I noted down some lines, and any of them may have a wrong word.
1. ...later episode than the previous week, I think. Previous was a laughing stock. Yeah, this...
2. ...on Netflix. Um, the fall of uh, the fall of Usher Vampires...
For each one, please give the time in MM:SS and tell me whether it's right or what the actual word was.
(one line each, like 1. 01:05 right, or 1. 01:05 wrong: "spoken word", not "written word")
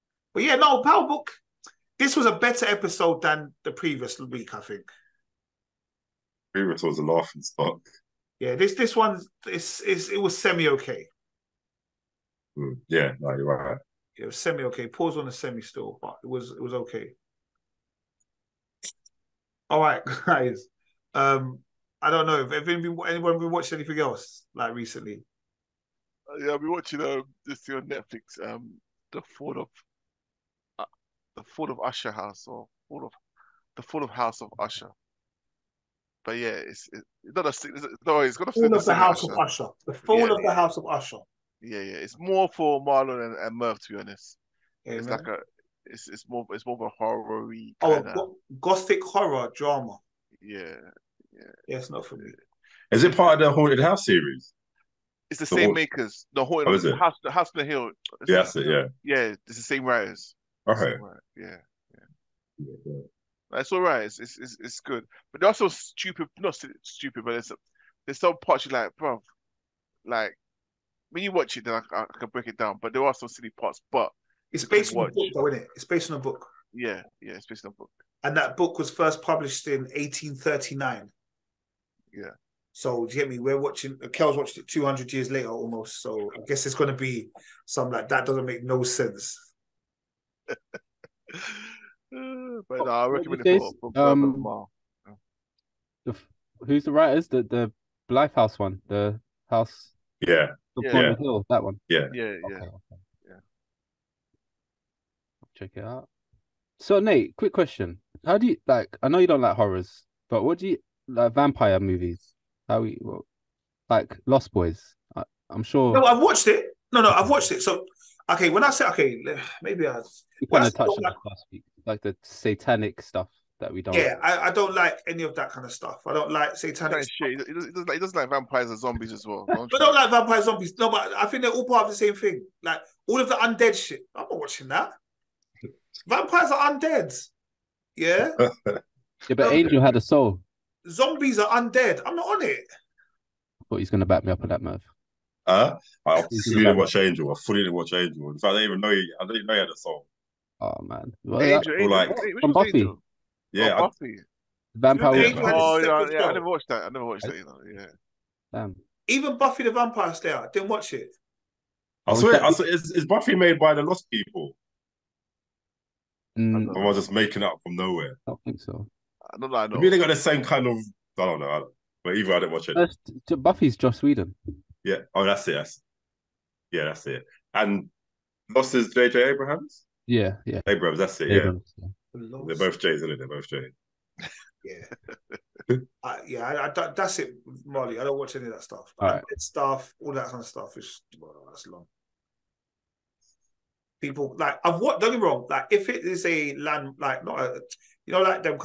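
1. 00:02 wrong: "better", not "later"
2. 00:27 wrong: "House", not "Vampires".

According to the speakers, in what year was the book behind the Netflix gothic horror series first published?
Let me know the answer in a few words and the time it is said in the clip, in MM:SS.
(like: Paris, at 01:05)
1839, at 01:19.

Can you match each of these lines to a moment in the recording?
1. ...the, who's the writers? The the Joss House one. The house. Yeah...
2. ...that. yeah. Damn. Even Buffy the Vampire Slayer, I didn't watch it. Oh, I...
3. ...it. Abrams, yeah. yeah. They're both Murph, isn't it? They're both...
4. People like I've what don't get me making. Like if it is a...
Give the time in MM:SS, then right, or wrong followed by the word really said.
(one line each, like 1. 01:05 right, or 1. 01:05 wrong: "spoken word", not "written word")
1. 01:36 wrong: "Blythe", not "Joss"
2. 02:37 right
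3. 03:01 wrong: "Jays", not "Murph"
4. 03:14 wrong: "wrong", not "making".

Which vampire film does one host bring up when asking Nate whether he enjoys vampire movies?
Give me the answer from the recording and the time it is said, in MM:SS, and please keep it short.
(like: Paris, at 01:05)
Lost Boys, at 01:54.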